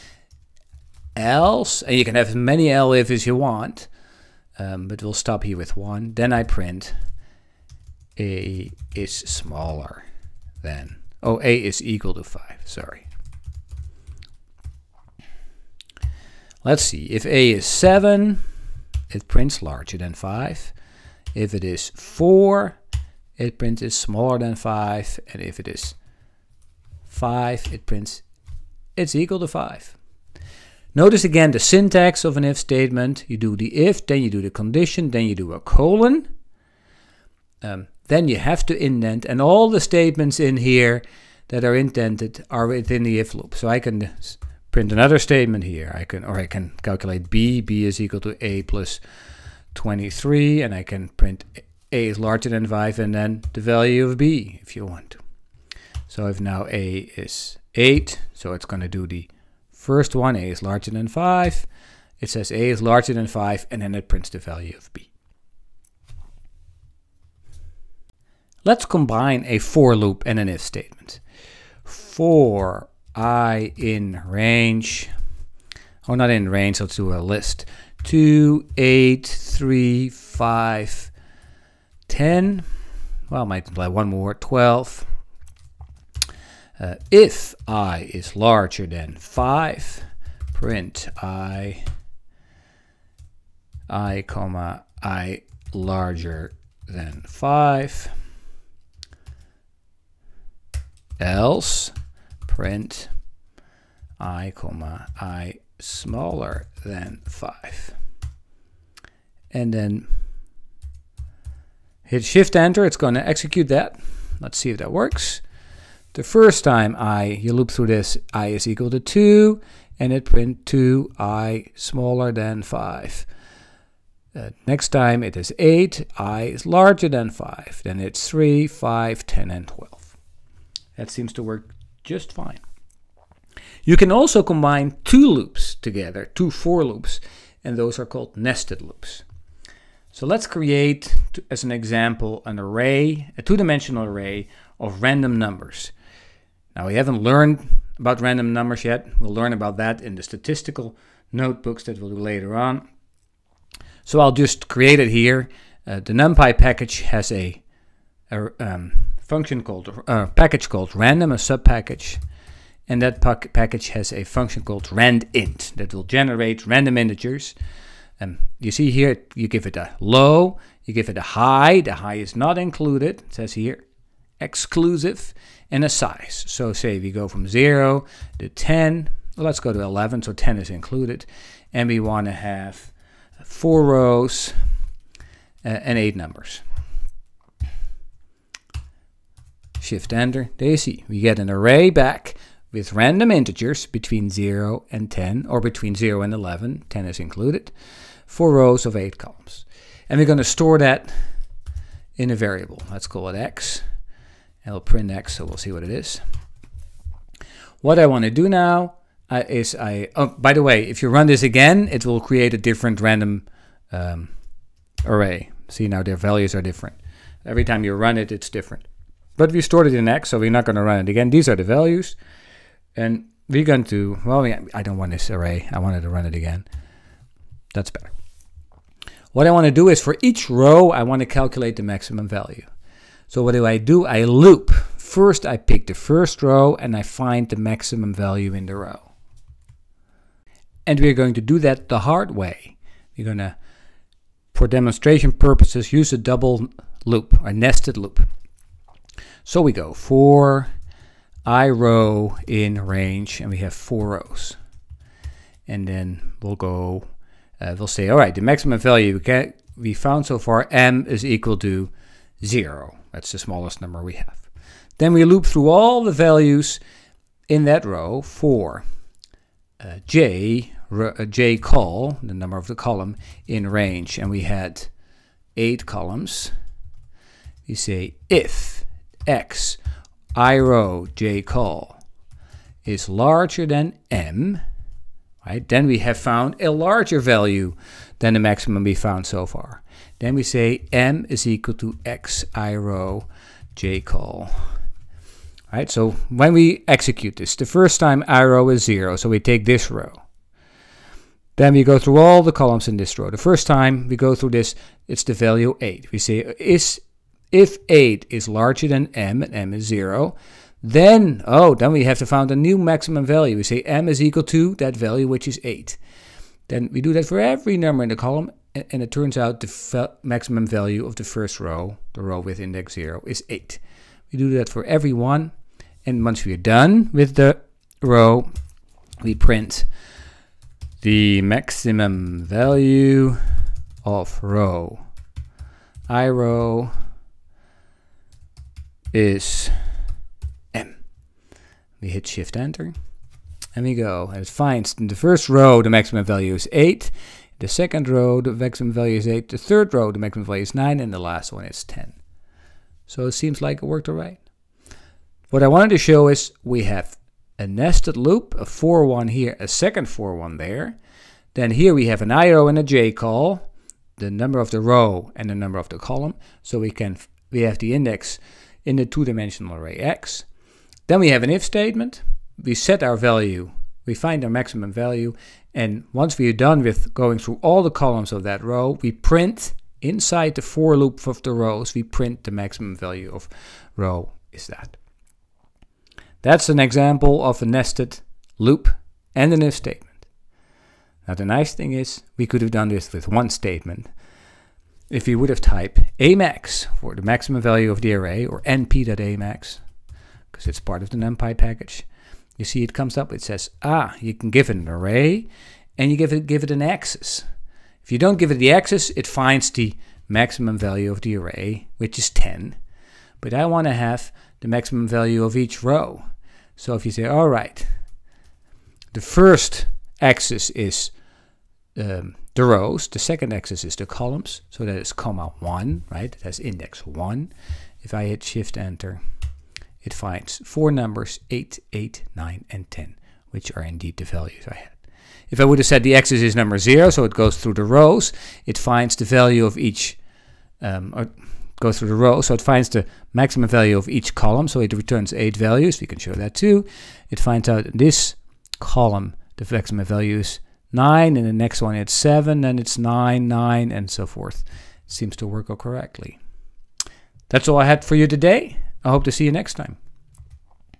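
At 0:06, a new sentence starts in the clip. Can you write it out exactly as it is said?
Then I print A is smaller than, oh, A is equal to five, sorry.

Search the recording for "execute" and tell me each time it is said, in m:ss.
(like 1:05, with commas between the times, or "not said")
1:53, 4:56.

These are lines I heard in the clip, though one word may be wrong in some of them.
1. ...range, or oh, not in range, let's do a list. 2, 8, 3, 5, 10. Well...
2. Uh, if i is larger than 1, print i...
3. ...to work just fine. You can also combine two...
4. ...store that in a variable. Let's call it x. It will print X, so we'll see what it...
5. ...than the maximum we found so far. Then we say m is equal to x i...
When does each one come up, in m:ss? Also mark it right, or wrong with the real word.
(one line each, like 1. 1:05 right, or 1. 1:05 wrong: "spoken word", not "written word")
1. 1:14 right
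2. 1:26 wrong: "5", not "1"
3. 2:11 right
4. 3:20 right
5. 4:48 right.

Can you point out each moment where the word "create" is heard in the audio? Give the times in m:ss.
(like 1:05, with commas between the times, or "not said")
2:20, 2:34, 3:32.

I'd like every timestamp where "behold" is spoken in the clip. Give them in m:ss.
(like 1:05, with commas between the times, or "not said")
not said.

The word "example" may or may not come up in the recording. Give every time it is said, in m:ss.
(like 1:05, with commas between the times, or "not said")
2:21, 6:26.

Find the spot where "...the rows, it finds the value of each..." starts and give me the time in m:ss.
7:17.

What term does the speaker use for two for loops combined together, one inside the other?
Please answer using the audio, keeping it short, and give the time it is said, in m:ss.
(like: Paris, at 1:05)
nested loops, at 2:18.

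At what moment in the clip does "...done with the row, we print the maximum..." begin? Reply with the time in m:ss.
5:26.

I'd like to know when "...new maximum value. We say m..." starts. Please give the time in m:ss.
5:12.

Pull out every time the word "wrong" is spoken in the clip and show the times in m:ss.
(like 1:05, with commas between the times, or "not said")
not said.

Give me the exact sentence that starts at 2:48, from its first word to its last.
Um, you see here, you give it a low, you give it a high.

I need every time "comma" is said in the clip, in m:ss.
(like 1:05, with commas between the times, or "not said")
1:34, 1:44, 7:05.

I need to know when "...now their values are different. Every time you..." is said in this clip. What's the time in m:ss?
3:35.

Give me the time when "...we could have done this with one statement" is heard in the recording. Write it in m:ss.
6:32.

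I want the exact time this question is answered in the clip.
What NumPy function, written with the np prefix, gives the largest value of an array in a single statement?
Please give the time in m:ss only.
6:38.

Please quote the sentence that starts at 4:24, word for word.
Then we loop through all the values in that row for uh, j uh, call, the number of the column, in range.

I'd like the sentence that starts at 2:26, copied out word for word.
Now, we haven't learned about random numbers yet.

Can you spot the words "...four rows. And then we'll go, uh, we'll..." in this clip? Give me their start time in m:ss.
4:13.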